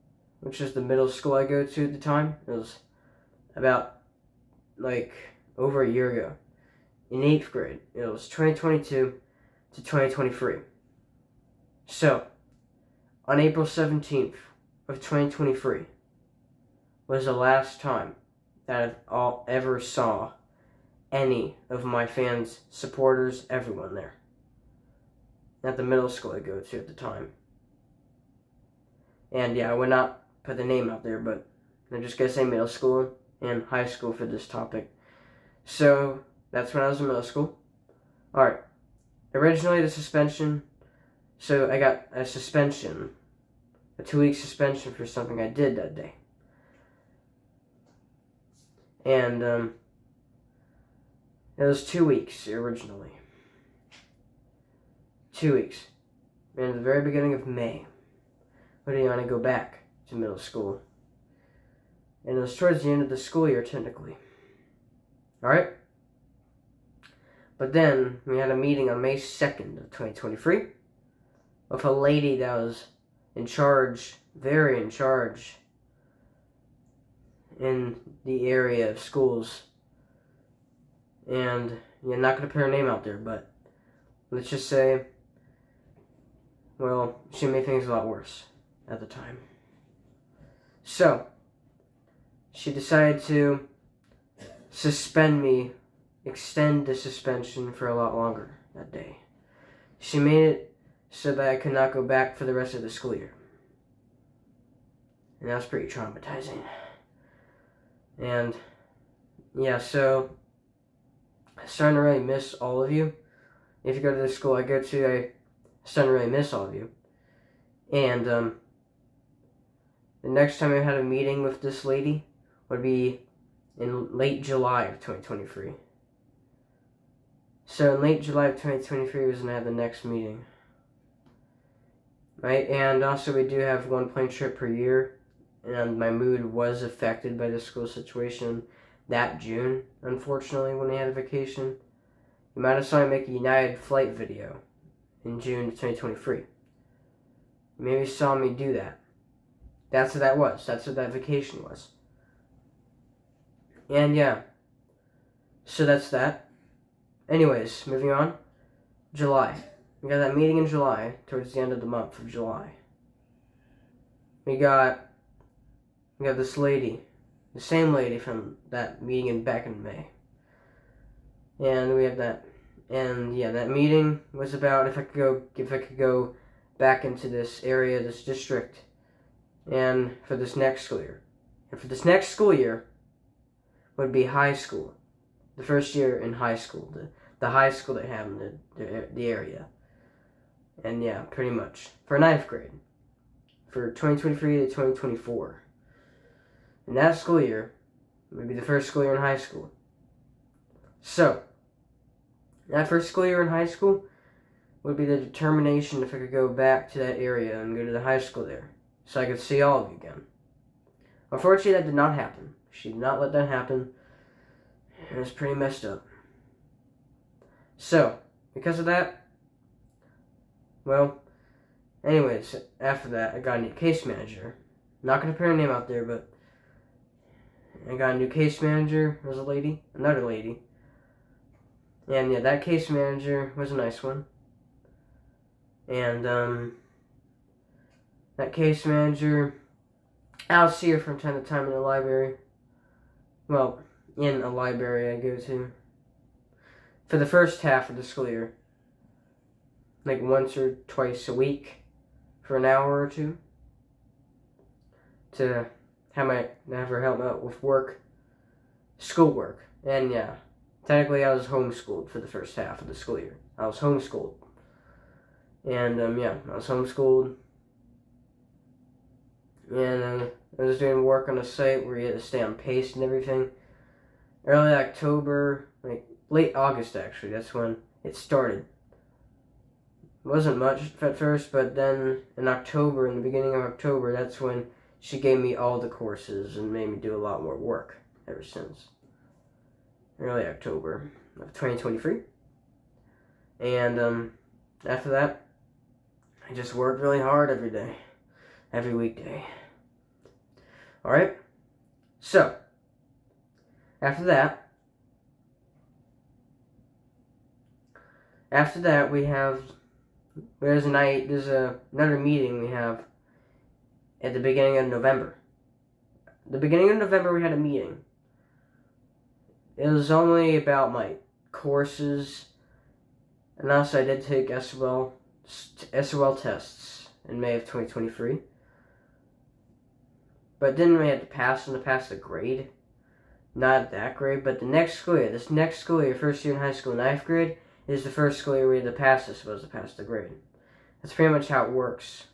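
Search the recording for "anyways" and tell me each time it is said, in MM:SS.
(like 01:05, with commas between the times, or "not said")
02:37, 03:42.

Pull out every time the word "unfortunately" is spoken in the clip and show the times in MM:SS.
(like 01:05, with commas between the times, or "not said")
02:20, 03:31.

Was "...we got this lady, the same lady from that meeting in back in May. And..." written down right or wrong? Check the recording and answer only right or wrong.
right.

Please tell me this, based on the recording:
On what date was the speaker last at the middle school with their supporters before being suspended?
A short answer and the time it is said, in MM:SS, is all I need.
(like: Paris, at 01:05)
April 17, 2023, at 00:13.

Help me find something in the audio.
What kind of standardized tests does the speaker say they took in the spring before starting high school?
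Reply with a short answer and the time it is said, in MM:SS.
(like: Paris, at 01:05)
SOL tests, at 05:25.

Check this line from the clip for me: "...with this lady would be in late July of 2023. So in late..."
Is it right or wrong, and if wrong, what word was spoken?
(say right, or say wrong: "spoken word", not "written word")
right.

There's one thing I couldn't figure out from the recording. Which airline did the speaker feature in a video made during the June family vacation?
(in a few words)
United.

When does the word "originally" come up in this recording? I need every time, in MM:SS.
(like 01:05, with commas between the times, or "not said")
00:39, 00:52.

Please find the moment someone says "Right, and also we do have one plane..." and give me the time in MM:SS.
02:12.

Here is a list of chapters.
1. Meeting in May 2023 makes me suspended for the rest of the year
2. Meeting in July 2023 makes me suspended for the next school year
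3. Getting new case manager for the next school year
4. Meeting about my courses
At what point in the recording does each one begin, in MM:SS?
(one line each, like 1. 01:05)
1. 01:07
2. 01:59
3. 03:40
4. 05:16.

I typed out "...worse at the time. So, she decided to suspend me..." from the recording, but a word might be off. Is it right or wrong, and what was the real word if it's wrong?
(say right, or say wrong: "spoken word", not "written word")
right.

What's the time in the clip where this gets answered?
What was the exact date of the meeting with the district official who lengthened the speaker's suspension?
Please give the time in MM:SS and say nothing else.
01:09.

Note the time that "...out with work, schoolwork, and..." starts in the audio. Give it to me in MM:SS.
04:17.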